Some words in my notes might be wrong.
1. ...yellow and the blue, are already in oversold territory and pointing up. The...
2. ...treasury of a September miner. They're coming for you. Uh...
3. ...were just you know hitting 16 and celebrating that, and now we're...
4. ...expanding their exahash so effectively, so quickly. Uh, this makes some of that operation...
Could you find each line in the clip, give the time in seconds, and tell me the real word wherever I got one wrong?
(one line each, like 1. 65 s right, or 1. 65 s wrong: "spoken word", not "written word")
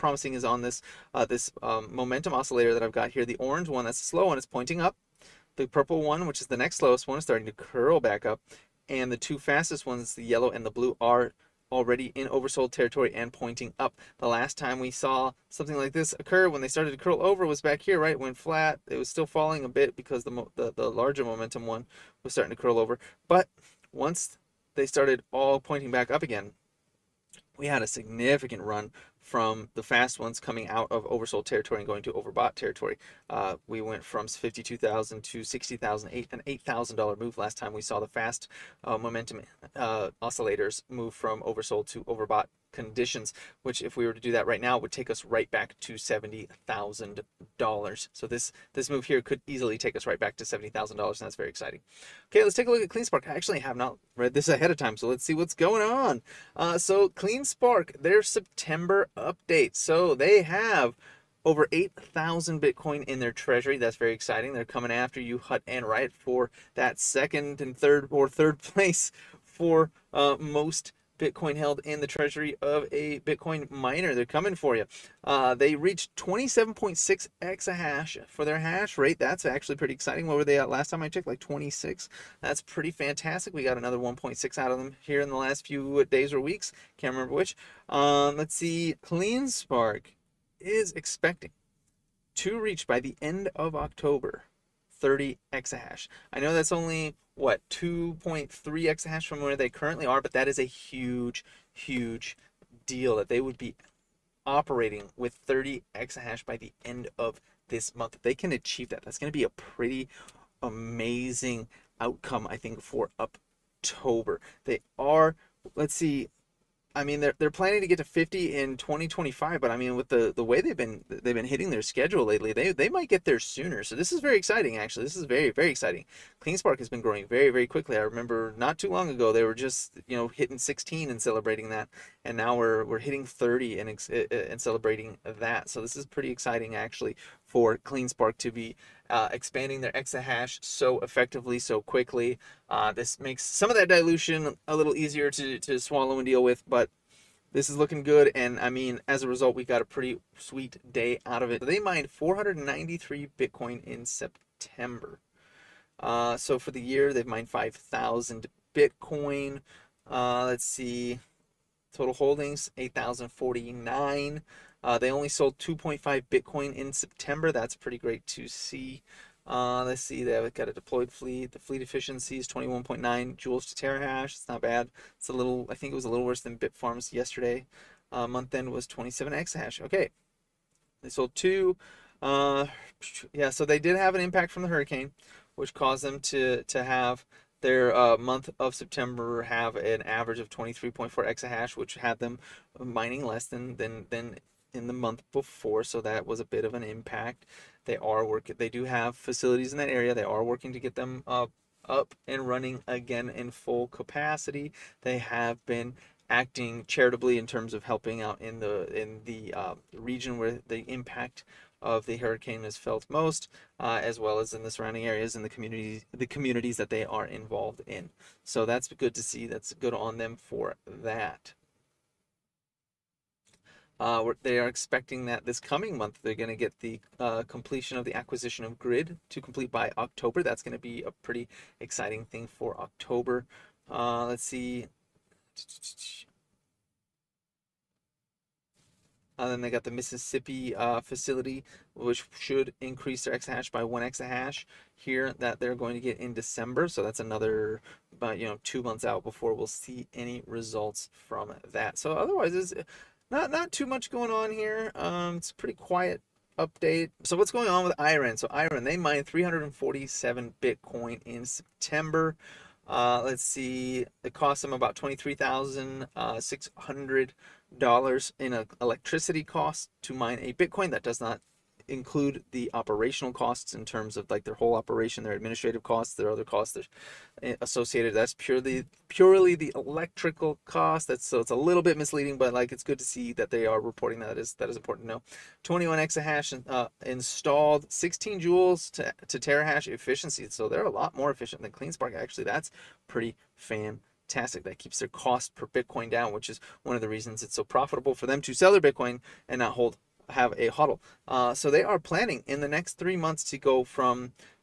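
1. 10 s right
2. 72 s wrong: "Bitcoin", not "September"
3. 129 s right
4. 139 s wrong: "dilution", not "operation".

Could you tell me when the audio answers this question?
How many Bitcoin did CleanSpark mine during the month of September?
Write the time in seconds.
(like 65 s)
152 s.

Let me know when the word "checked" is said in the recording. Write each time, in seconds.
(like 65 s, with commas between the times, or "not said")
81 s.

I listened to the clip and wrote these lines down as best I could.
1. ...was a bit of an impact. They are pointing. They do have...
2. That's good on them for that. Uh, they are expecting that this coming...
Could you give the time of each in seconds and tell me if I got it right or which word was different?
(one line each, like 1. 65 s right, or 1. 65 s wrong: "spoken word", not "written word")
1. 196 s wrong: "working", not "pointing"
2. 219 s right.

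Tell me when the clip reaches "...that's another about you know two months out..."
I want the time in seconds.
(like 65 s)
247 s.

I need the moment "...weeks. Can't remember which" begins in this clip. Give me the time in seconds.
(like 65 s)
86 s.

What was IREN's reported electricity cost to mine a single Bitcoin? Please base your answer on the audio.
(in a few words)
$23,600.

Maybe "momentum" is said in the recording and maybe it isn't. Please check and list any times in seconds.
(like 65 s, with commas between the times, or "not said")
1 s, 21 s, 38 s.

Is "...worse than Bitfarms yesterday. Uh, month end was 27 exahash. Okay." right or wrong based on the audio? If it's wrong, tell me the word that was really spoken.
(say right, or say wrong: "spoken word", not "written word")
right.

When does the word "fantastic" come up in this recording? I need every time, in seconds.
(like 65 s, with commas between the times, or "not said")
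82 s, 294 s.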